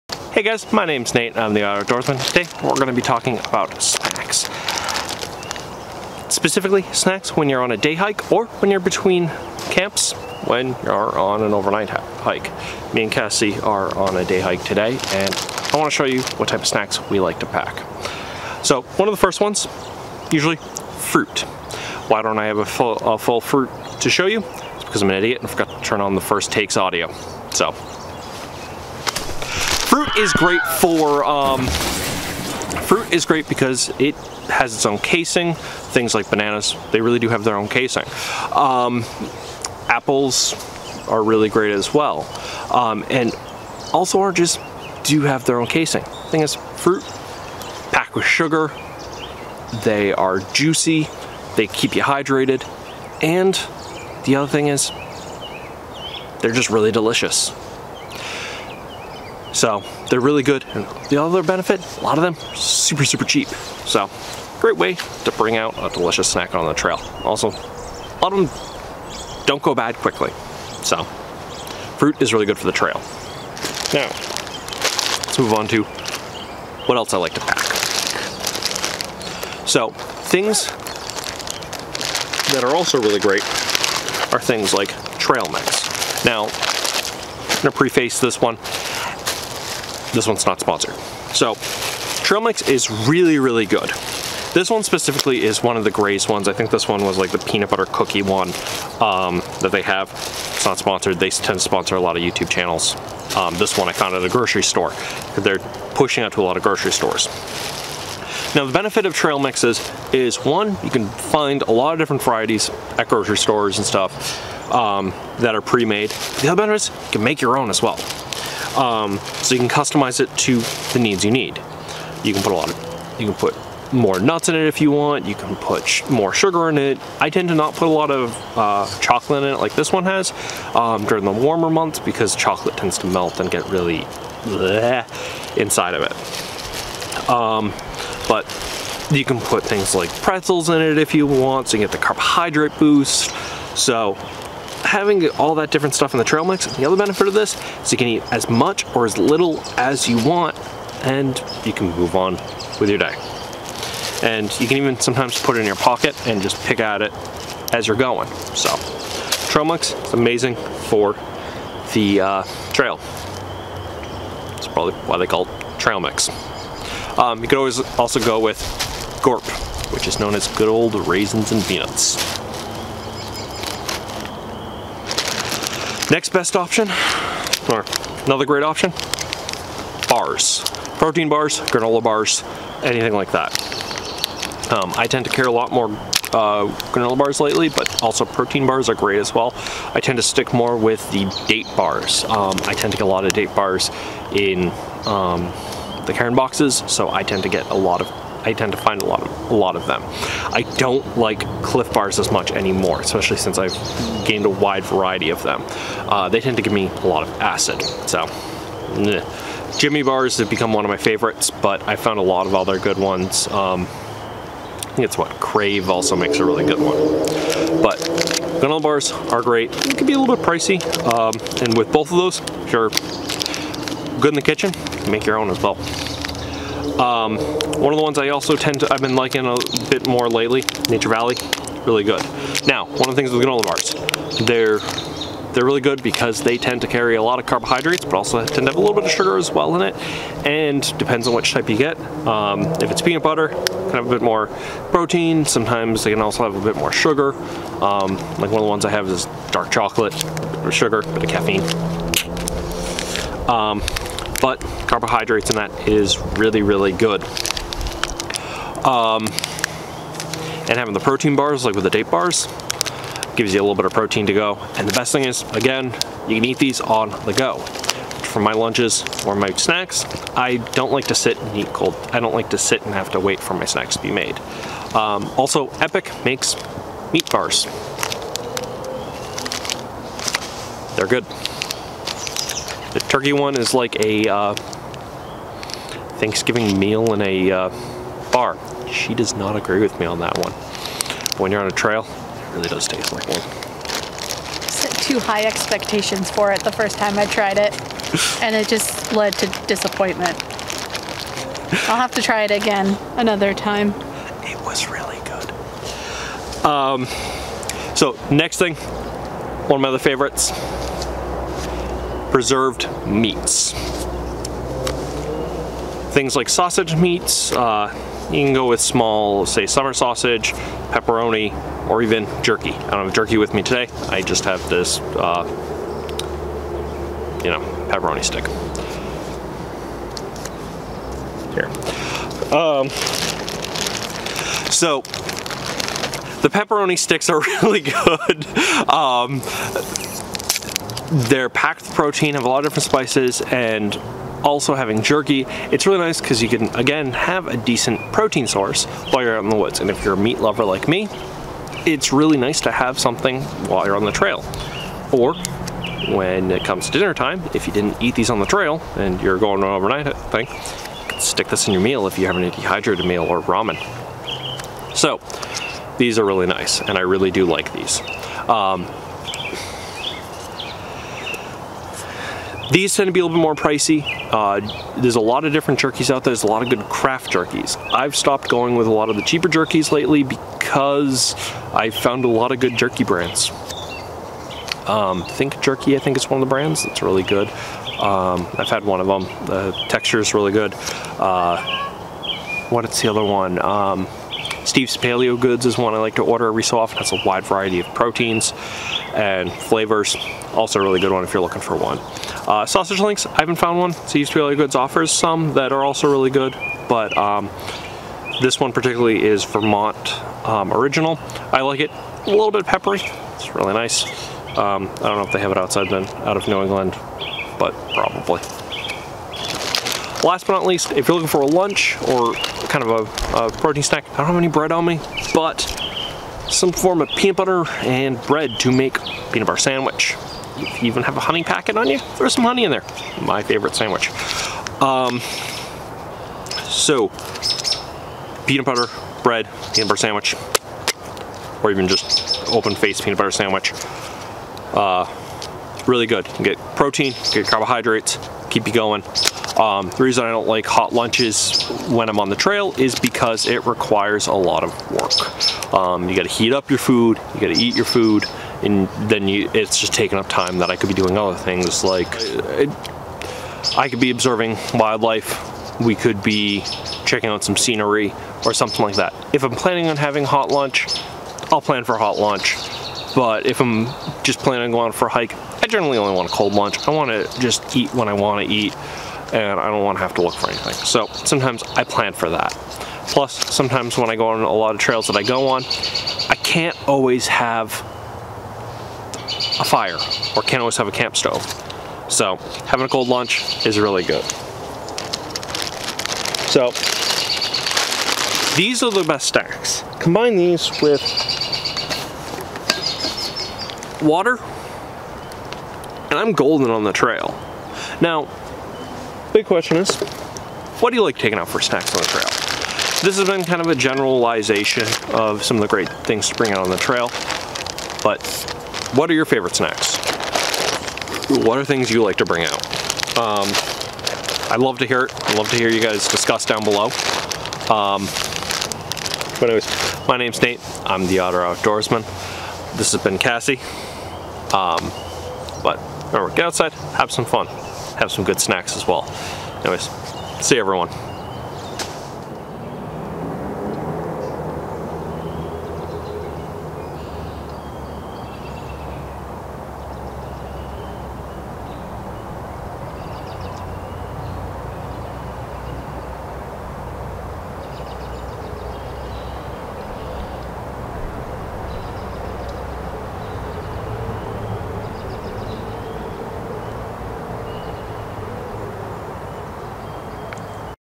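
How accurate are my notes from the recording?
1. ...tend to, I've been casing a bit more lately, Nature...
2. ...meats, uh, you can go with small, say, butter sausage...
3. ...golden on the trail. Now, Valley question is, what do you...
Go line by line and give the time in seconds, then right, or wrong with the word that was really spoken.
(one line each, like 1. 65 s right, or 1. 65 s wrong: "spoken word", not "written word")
1. 228 s wrong: "liking", not "casing"
2. 316 s wrong: "summer", not "butter"
3. 506 s wrong: "Big", not "Valley".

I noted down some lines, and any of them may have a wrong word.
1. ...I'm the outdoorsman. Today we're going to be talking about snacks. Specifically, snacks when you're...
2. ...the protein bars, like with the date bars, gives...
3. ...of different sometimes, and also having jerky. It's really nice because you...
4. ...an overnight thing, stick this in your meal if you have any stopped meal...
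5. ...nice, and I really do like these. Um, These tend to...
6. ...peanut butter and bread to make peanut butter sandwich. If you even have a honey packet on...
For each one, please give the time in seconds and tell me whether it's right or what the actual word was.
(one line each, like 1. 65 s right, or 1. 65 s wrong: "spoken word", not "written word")
1. 1 s right
2. 260 s right
3. 342 s wrong: "spices", not "sometimes"
4. 359 s wrong: "dehydrated", not "stopped"
5. 366 s right
6. 427 s right.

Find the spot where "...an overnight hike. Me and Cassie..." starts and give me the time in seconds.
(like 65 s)
11 s.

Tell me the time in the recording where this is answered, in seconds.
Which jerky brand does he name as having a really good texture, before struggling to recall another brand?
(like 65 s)
385 s.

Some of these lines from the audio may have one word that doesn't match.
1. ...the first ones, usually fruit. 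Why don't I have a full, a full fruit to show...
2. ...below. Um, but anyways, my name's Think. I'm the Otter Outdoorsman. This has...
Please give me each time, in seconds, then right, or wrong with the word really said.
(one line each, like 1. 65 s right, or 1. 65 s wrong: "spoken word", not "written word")
1. 19 s right
2. 526 s wrong: "Nate", not "Think".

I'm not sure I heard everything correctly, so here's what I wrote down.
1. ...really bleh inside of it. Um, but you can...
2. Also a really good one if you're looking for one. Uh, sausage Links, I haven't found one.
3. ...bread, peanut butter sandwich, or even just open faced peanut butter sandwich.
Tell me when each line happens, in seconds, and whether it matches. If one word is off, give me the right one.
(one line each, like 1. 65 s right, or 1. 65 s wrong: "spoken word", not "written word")
1. 133 s right
2. 400 s right
3. 439 s right.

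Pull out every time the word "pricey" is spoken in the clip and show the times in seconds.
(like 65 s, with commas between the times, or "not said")
220 s, 373 s.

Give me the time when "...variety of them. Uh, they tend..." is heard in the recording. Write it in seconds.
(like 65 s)
204 s.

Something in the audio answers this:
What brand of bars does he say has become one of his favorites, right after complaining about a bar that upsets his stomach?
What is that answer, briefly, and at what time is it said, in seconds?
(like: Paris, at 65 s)
Jimmy Bars, at 209 s.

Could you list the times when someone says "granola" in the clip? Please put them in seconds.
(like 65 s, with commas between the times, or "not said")
181 s, 186 s, 218 s, 233 s.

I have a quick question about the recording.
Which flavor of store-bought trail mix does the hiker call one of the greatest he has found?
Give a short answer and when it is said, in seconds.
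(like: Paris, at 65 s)
peanut butter cookie, at 97 s.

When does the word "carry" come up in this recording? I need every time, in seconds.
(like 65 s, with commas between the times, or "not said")
185 s, 236 s.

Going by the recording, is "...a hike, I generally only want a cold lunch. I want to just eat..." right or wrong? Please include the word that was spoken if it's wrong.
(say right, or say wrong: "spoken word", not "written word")
right.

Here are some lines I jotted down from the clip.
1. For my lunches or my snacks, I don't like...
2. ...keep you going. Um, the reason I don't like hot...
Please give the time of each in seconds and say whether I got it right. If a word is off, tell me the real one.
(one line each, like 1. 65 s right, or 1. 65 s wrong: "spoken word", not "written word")
1. 268 s right
2. 448 s right.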